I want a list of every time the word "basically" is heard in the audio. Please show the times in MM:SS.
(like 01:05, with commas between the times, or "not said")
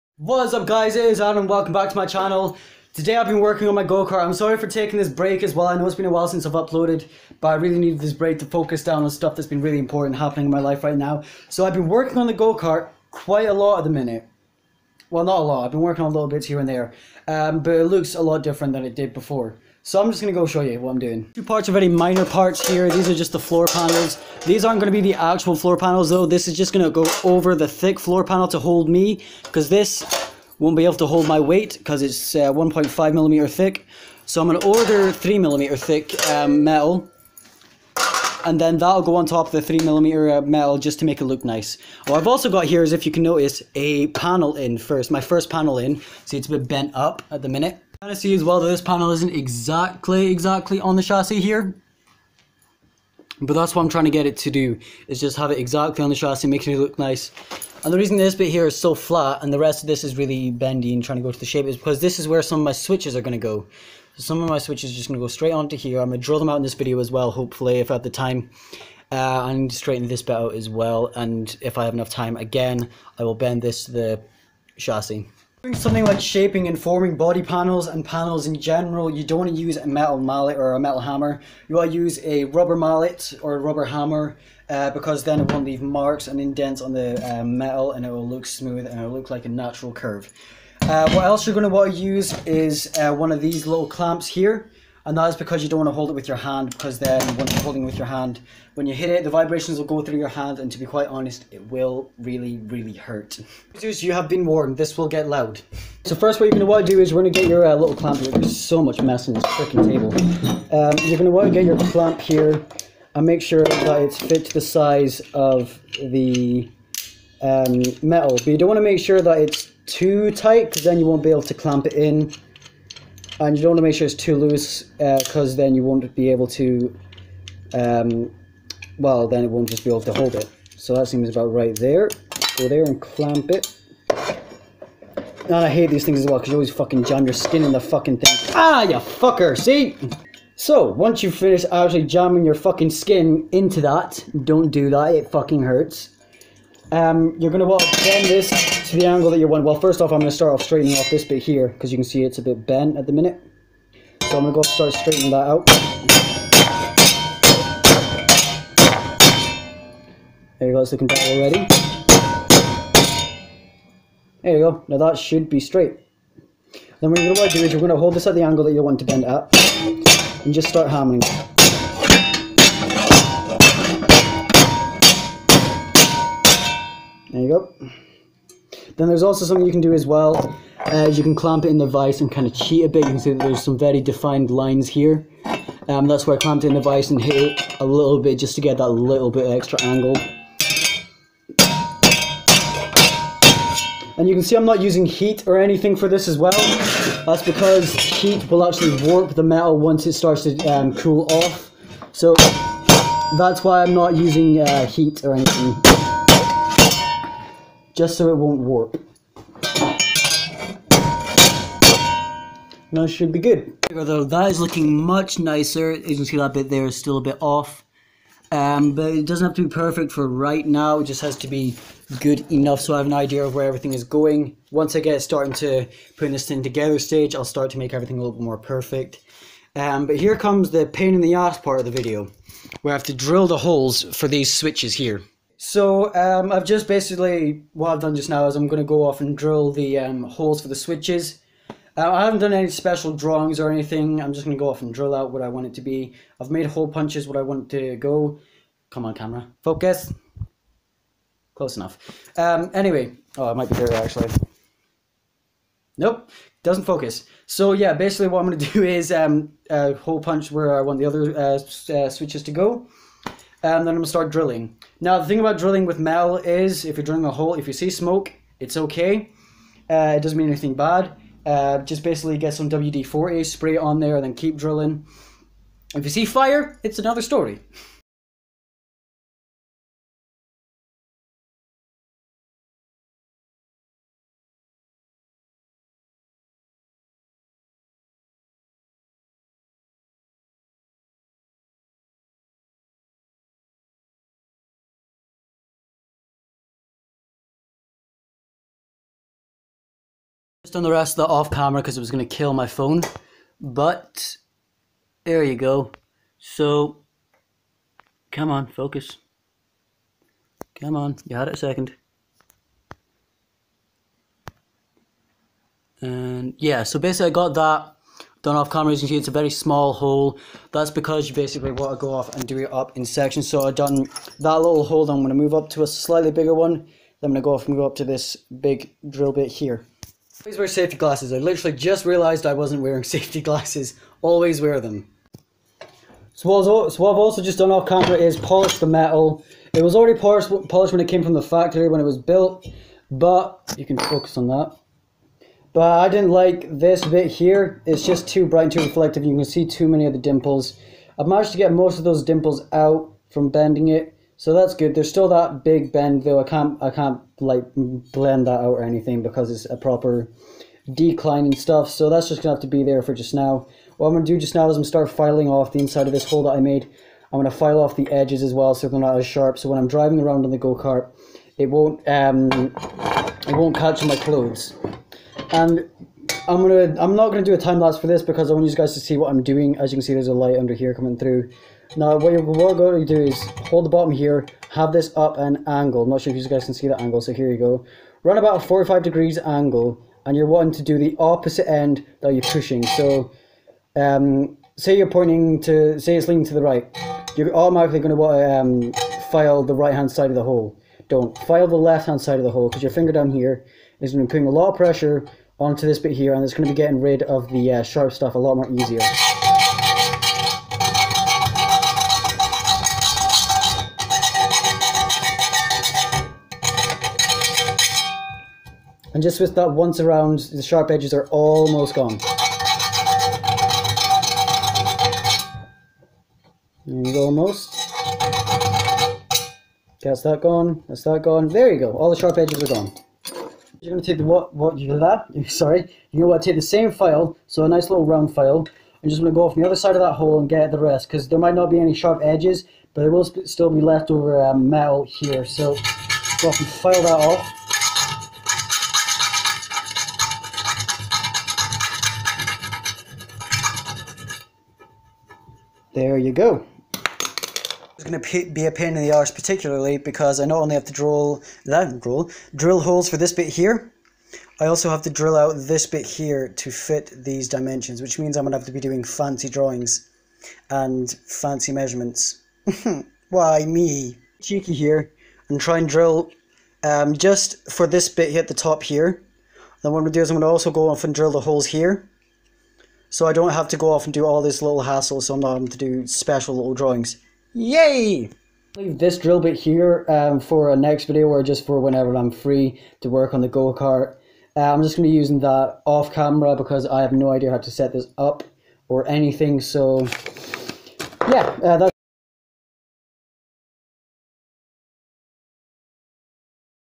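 03:56, 04:17, 04:32, 05:16, 05:21.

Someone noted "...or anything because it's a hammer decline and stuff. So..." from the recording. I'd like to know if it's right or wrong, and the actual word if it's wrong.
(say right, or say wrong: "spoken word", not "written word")
wrong: "proper", not "hammer".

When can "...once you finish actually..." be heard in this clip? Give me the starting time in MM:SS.
02:20.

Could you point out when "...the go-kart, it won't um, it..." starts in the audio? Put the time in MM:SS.
06:10.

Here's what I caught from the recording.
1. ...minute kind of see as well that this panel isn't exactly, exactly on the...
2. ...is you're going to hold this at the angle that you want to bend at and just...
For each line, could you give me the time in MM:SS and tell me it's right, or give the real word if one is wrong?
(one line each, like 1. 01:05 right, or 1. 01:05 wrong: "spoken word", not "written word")
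1. 00:47 right
2. 02:47 right.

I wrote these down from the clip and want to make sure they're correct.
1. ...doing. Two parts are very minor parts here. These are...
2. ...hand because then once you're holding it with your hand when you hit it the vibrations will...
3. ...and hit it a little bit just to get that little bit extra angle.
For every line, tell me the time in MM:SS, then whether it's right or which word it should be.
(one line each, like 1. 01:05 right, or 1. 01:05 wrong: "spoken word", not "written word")
1. 00:20 right
2. 01:36 right
3. 03:07 right.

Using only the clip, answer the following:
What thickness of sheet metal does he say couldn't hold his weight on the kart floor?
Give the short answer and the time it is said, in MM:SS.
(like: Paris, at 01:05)
1.5 millimeters, at 00:32.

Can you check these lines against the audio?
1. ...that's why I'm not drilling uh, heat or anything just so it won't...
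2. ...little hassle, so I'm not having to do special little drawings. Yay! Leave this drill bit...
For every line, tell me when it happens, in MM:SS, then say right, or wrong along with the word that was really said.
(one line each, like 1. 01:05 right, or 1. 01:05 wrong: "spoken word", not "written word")
1. 03:23 wrong: "using", not "drilling"
2. 08:04 right.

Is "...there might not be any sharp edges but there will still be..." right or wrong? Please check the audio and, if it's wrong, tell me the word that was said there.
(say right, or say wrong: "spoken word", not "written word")
right.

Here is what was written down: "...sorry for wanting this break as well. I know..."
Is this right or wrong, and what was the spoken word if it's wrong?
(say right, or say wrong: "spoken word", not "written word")
wrong: "taking", not "wanting".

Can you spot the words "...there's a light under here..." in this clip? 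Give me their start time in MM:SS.
06:20.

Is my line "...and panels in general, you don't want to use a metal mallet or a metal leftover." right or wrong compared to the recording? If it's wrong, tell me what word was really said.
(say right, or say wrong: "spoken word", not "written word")
wrong: "hammer", not "leftover".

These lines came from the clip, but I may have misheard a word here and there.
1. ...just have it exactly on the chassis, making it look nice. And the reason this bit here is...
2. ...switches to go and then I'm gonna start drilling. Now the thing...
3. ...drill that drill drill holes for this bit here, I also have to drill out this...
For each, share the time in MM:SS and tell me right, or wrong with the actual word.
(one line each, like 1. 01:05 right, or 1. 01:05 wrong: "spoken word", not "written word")
1. 00:55 right
2. 04:22 right
3. 07:40 right.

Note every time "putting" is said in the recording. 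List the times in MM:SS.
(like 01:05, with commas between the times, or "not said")
03:46, 06:44.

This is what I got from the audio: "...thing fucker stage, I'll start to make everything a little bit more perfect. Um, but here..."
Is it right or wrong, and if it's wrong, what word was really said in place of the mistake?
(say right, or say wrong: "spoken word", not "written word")
wrong: "together", not "fucker".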